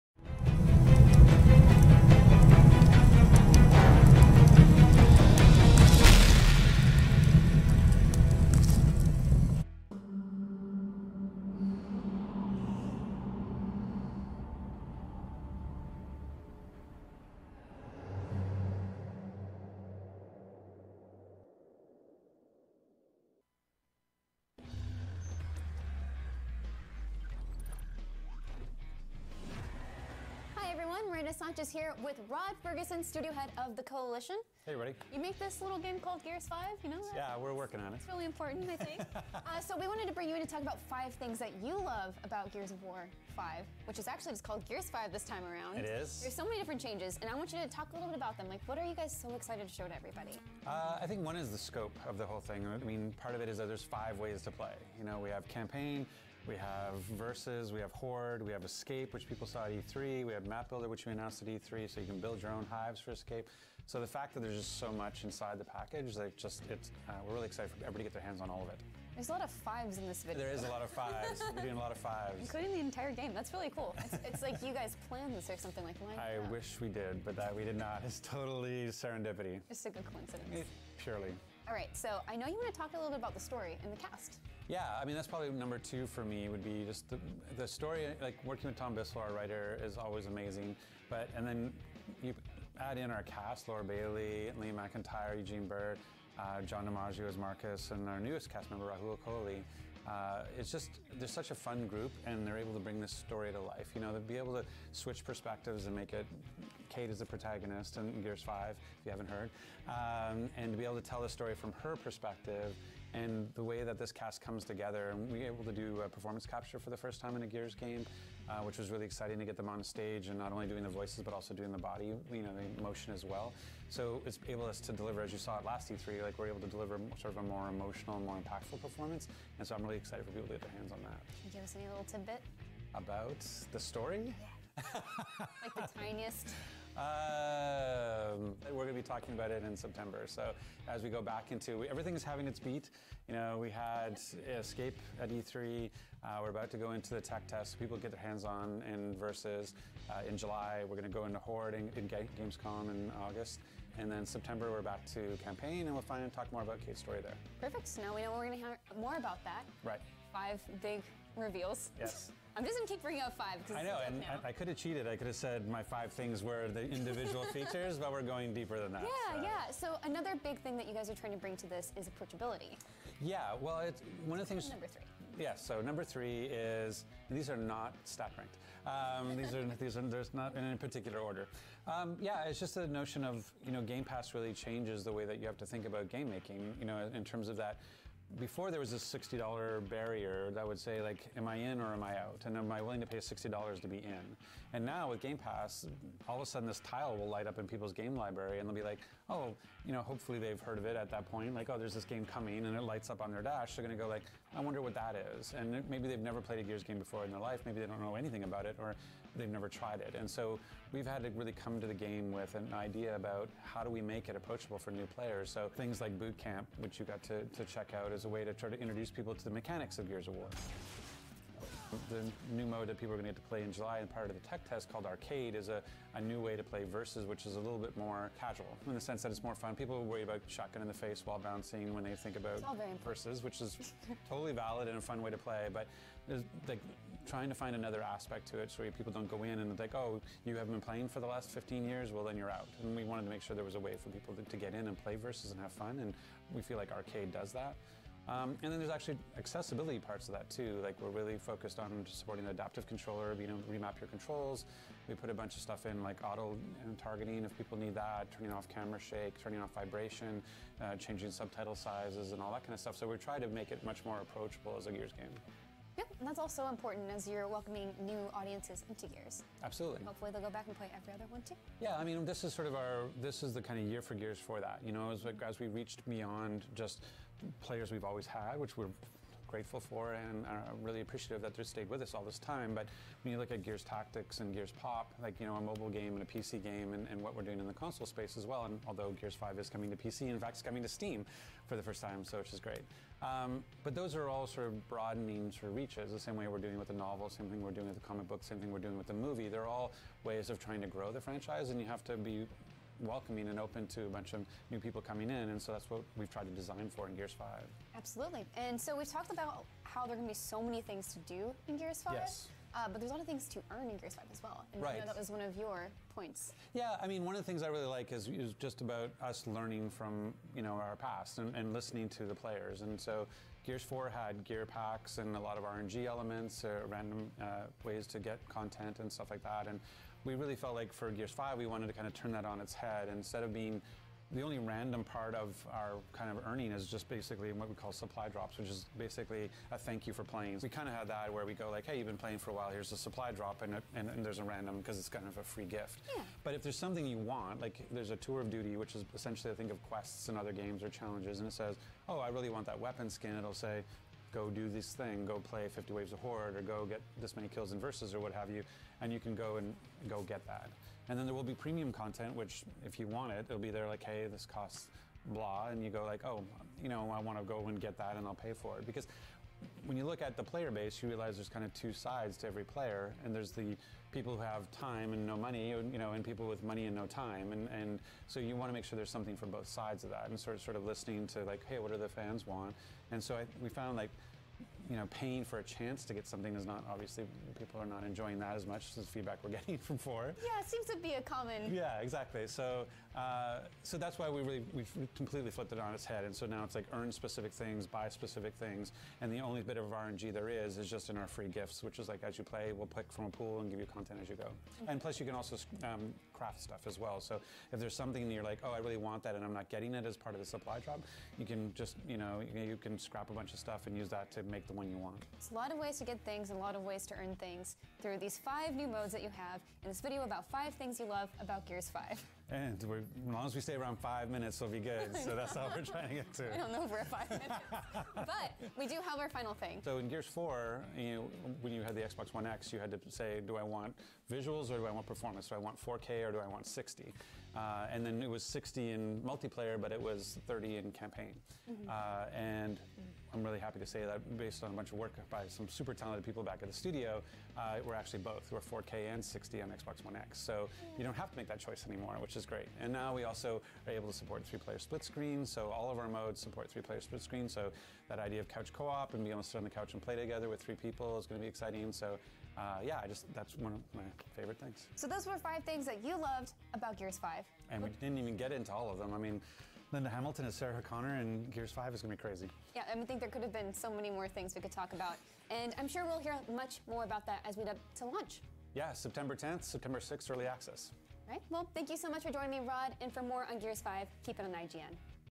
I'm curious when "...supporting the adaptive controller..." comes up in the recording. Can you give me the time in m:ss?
4:12.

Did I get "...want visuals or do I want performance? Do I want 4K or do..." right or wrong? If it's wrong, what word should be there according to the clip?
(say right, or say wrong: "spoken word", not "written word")
right.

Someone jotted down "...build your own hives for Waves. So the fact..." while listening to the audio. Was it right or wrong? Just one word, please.
wrong.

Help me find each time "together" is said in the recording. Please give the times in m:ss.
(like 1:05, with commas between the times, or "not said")
1:54, 7:40.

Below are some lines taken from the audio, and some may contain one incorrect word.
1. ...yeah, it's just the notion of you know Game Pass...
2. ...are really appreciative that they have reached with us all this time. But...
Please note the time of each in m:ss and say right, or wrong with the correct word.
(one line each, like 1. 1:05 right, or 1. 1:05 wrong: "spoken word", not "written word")
1. 3:02 right
2. 4:40 wrong: "stayed", not "reached".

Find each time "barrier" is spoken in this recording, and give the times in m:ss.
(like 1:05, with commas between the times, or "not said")
3:09.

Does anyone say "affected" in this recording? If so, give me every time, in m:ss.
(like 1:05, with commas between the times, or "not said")
not said.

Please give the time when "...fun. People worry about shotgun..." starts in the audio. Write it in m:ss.
3:49.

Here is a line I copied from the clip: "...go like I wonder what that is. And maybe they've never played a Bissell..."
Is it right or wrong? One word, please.
wrong.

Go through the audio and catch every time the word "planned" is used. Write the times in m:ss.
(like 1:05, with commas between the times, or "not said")
1:15.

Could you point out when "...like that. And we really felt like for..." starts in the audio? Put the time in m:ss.
5:29.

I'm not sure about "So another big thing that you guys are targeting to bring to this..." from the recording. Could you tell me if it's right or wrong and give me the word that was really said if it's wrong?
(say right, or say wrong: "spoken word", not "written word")
wrong: "trying", not "targeting".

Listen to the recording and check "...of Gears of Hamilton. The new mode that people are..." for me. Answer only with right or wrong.
wrong.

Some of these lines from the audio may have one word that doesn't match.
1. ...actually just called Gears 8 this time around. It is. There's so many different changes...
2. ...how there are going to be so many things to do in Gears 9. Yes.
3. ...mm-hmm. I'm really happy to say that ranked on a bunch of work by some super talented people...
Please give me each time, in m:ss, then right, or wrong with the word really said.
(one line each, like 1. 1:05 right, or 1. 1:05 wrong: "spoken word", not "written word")
1. 0:44 wrong: "5", not "8"
2. 5:09 wrong: "5", not "9"
3. 7:22 wrong: "based", not "ranked".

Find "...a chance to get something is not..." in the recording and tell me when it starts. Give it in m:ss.
6:25.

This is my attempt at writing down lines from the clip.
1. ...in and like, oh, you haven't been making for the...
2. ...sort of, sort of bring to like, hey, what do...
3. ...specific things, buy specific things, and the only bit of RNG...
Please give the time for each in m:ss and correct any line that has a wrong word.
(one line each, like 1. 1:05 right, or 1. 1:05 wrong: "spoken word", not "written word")
1. 3:59 wrong: "playing", not "making"
2. 6:20 wrong: "listening", not "bring"
3. 6:37 right.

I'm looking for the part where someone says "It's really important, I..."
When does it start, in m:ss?
0:37.